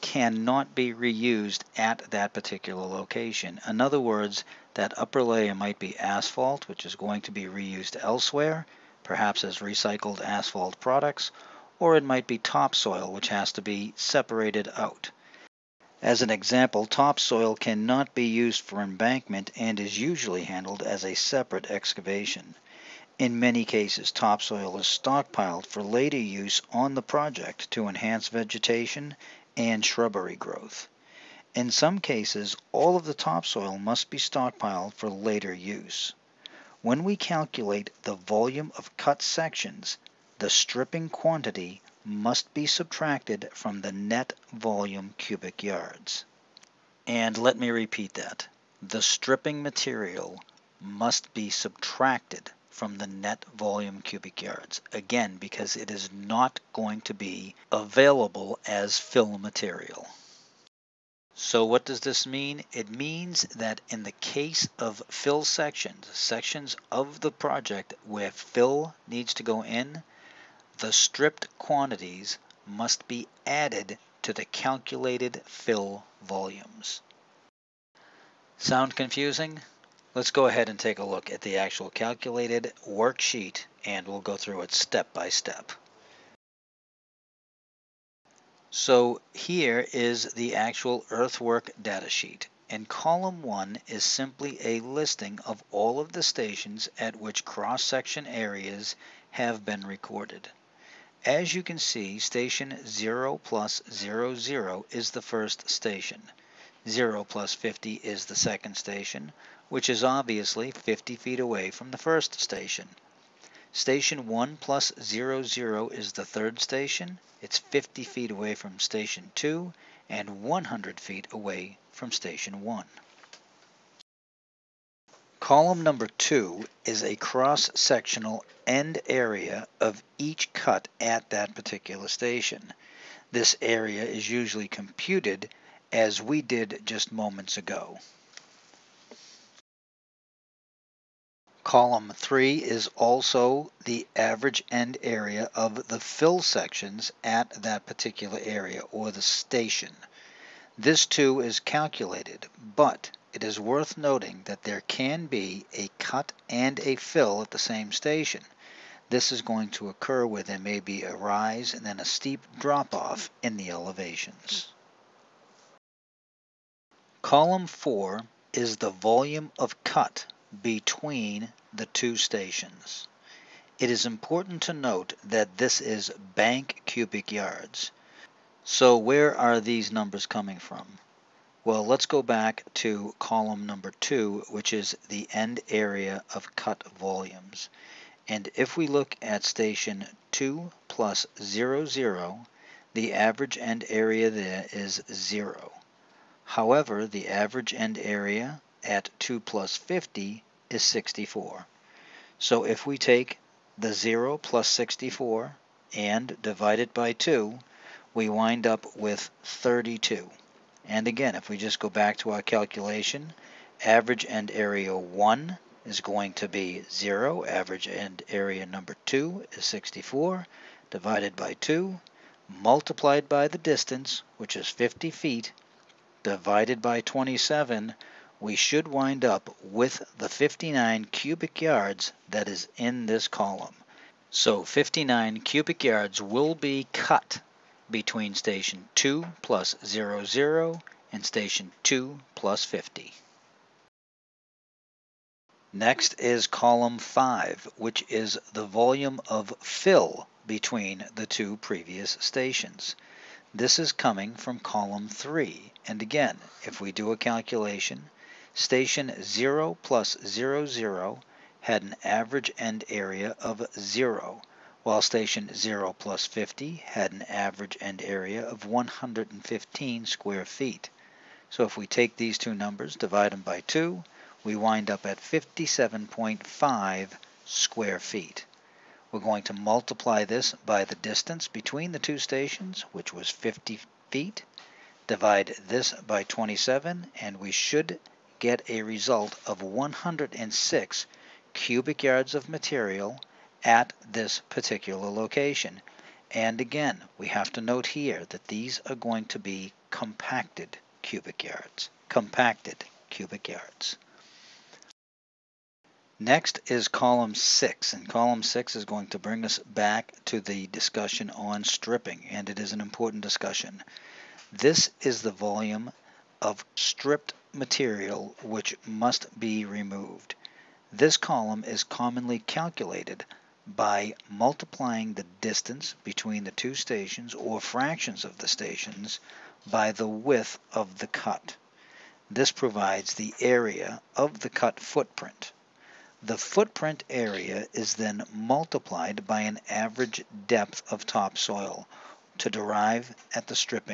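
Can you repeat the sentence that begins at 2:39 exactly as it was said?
This is going to occur where there may be a rise and then a steep drop off in the elevations.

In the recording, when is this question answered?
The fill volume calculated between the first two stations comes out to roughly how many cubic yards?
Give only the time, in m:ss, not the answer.
4:49.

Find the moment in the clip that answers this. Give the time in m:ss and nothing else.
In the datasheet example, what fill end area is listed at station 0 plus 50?
4:28.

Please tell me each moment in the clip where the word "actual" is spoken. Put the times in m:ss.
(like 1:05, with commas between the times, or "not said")
1:21, 1:30.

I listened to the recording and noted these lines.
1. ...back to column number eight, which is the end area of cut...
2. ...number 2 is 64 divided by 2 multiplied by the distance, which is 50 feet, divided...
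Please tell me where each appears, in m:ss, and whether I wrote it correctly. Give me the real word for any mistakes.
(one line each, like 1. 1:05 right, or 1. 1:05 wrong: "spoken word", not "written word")
1. 3:02 wrong: "two", not "eight"
2. 3:38 right.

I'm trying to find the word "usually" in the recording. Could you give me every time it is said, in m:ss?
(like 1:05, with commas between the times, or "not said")
0:19, 2:14.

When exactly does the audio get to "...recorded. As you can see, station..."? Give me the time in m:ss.
1:39.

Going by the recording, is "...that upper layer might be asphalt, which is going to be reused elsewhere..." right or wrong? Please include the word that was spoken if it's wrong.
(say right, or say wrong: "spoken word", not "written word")
right.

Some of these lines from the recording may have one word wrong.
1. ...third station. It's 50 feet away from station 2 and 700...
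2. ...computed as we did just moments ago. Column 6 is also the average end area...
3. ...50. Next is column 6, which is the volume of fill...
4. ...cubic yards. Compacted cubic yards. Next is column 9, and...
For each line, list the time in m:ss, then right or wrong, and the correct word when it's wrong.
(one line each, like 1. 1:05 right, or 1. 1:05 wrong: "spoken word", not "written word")
1. 1:56 wrong: "100", not "700"
2. 2:14 wrong: "3", not "6"
3. 4:02 wrong: "5", not "6"
4. 5:01 wrong: "6", not "9".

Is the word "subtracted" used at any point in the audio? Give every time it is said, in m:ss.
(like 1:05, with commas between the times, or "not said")
0:42, 0:51.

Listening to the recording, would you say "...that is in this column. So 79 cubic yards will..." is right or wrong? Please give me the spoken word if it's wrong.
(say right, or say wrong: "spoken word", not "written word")
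wrong: "59", not "79".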